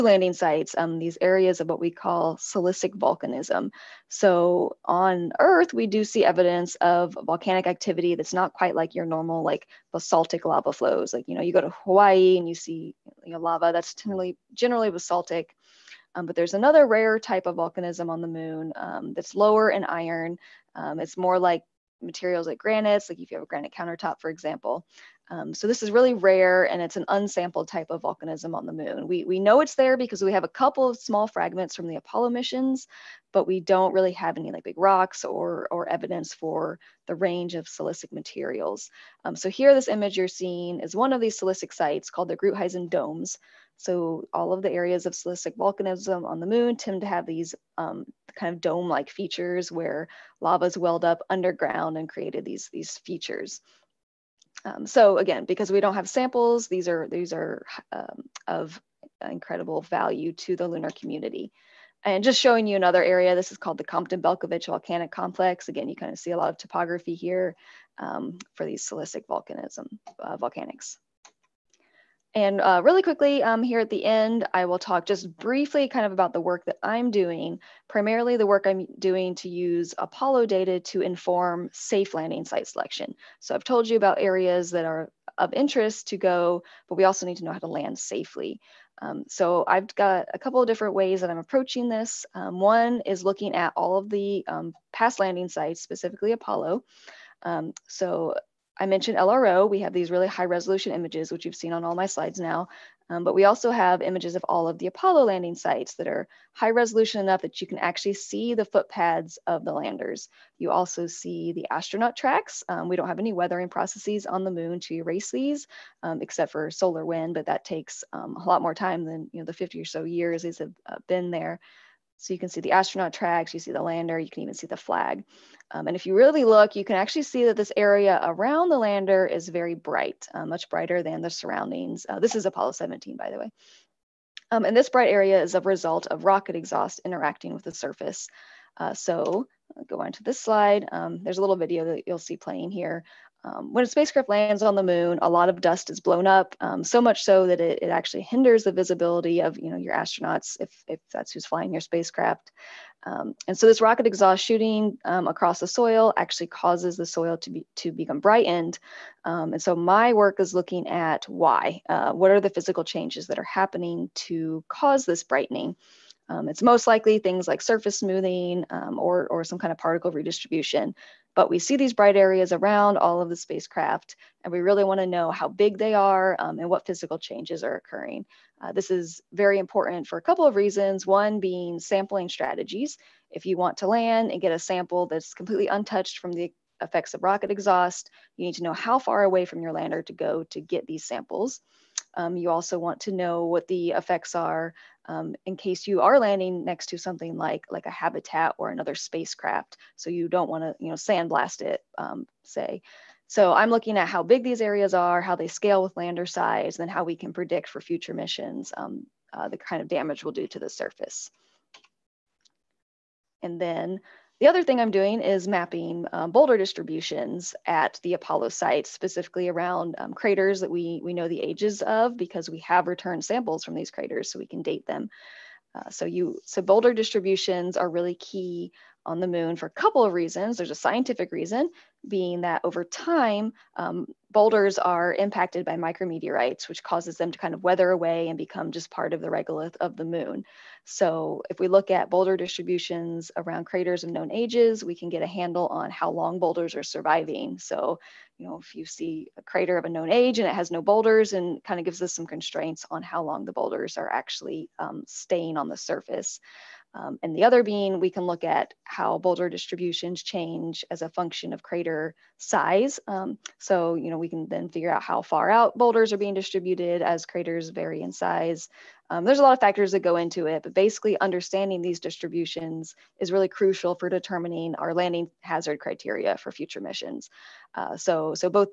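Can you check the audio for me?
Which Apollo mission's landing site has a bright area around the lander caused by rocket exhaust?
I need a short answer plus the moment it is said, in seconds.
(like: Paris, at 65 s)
Apollo 17, at 132 s.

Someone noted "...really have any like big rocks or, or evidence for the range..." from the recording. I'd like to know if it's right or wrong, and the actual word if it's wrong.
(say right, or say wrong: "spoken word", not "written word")
right.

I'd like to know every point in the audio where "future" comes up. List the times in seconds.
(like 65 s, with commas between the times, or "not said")
207 s, 276 s.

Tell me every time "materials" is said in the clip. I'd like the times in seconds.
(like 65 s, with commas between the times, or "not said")
22 s, 38 s.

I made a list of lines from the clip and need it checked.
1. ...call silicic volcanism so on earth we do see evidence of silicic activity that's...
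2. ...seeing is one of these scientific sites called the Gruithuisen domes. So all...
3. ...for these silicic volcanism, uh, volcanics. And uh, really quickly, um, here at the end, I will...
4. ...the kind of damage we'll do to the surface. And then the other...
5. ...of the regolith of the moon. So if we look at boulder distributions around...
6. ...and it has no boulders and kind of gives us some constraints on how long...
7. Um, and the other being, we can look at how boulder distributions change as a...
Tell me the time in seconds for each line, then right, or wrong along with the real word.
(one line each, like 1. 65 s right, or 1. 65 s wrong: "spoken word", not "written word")
1. 1 s wrong: "volcanic", not "silicic"
2. 40 s wrong: "silicic", not "scientific"
3. 68 s right
4. 209 s right
5. 239 s right
6. 250 s right
7. 256 s right.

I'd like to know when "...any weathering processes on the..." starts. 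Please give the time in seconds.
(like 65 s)
113 s.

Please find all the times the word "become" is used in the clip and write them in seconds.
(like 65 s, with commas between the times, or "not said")
157 s, 238 s.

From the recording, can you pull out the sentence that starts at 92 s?
Um, one is looking at all of the um, past landing sites, specifically Apollo.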